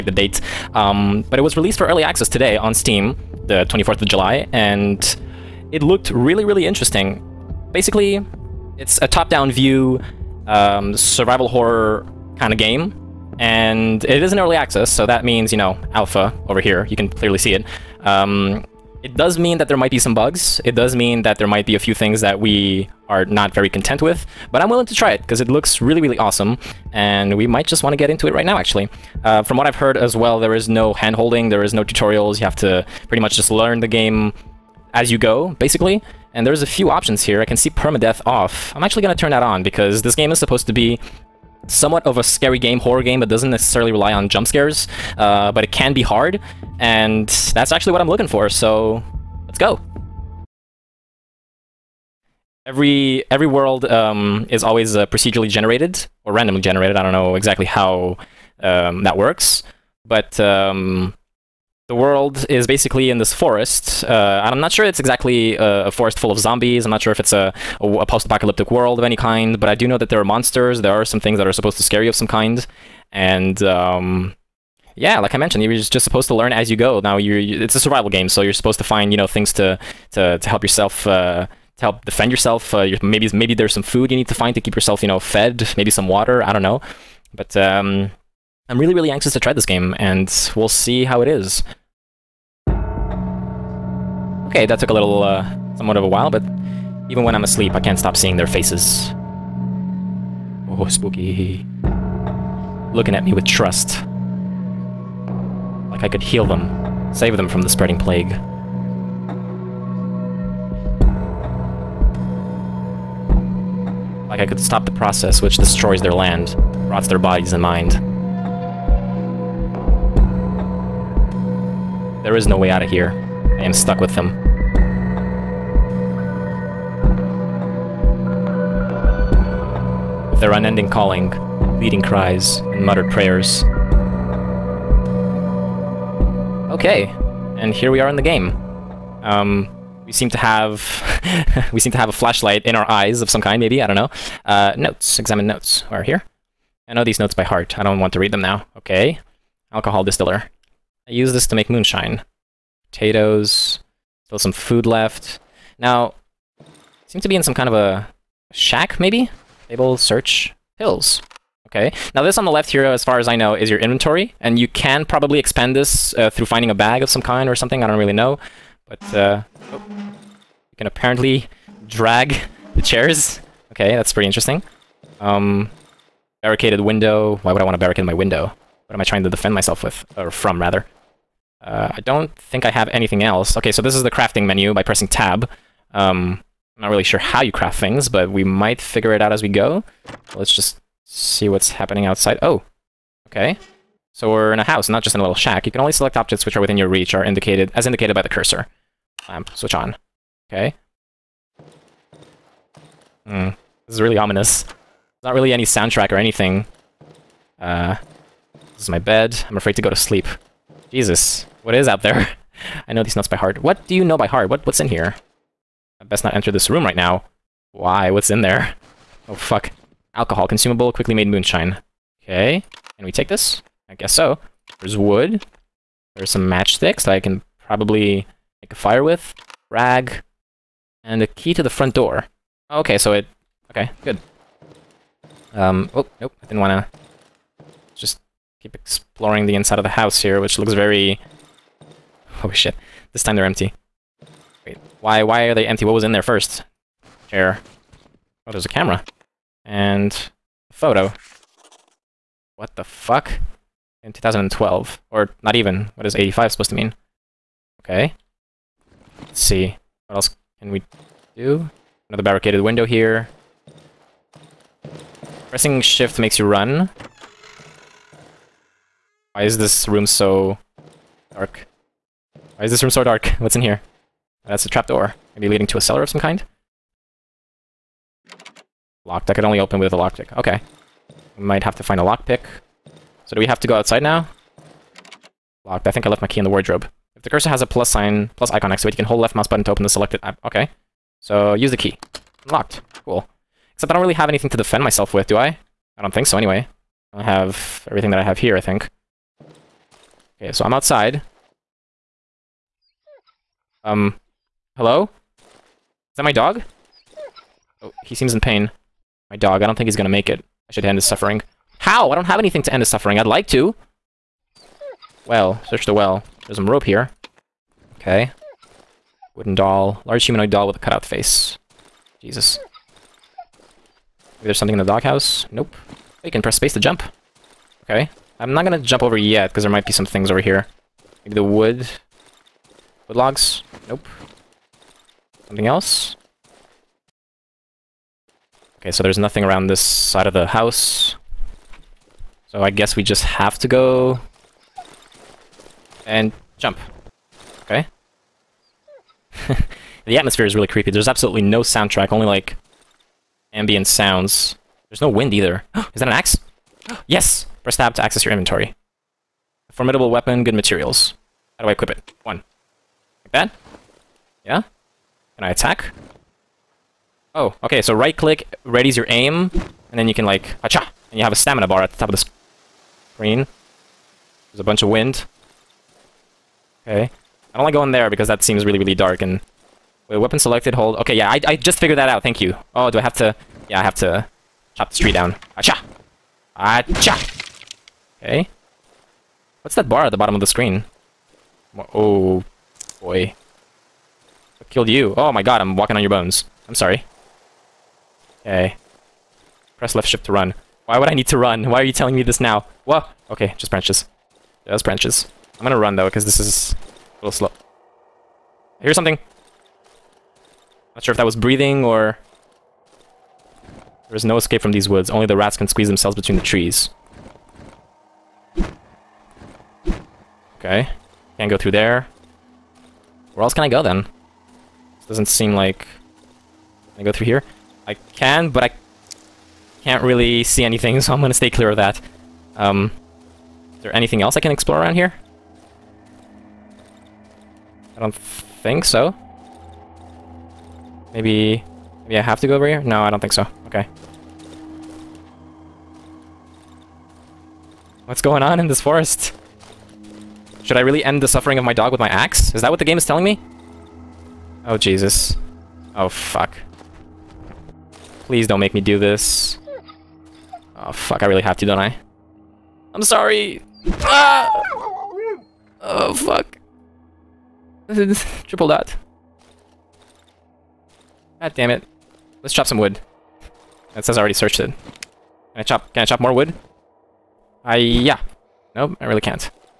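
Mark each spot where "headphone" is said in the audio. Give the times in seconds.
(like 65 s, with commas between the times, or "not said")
not said.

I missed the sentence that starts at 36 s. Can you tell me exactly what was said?
And there's a few options here.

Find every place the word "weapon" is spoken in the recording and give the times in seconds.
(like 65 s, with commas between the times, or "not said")
360 s, 380 s.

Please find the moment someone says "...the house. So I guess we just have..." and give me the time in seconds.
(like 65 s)
340 s.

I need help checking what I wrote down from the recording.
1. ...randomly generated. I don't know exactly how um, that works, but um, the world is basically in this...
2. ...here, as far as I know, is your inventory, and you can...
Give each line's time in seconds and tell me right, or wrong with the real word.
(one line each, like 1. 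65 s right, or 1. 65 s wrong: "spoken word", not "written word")
1. 56 s right
2. 162 s right.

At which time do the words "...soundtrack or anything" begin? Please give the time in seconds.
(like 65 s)
205 s.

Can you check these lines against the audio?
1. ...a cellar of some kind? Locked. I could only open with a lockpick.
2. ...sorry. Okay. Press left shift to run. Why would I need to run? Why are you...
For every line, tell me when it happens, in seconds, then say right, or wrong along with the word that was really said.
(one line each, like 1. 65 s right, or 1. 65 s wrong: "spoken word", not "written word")
1. 275 s right
2. 396 s right.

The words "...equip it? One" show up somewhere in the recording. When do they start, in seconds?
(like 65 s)
361 s.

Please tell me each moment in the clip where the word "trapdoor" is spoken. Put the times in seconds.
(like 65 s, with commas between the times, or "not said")
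274 s.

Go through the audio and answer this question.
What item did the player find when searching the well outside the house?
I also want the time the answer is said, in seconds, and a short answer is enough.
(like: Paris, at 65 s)
Rope, at 316 s.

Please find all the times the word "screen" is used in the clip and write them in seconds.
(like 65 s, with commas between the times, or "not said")
373 s, 390 s.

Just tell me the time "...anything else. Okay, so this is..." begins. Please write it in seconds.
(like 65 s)
182 s.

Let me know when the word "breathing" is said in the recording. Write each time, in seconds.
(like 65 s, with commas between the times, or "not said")
411 s.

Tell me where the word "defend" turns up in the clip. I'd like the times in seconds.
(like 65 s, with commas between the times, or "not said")
82 s, 179 s, 294 s.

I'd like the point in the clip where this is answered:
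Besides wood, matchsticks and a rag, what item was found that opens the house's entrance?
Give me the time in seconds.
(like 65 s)
231 s.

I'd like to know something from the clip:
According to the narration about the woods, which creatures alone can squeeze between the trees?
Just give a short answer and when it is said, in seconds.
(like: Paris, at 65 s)
Rats, at 415 s.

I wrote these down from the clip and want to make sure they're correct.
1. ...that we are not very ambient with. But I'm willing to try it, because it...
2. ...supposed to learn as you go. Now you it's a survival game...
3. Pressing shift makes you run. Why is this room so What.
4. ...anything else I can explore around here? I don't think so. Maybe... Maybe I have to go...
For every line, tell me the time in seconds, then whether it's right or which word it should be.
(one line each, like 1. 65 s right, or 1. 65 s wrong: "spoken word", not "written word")
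1. 22 s wrong: "content", not "ambient"
2. 76 s right
3. 265 s wrong: "Dark", not "What"
4. 433 s right.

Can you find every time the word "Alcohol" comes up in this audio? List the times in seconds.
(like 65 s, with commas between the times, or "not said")
149 s, 220 s.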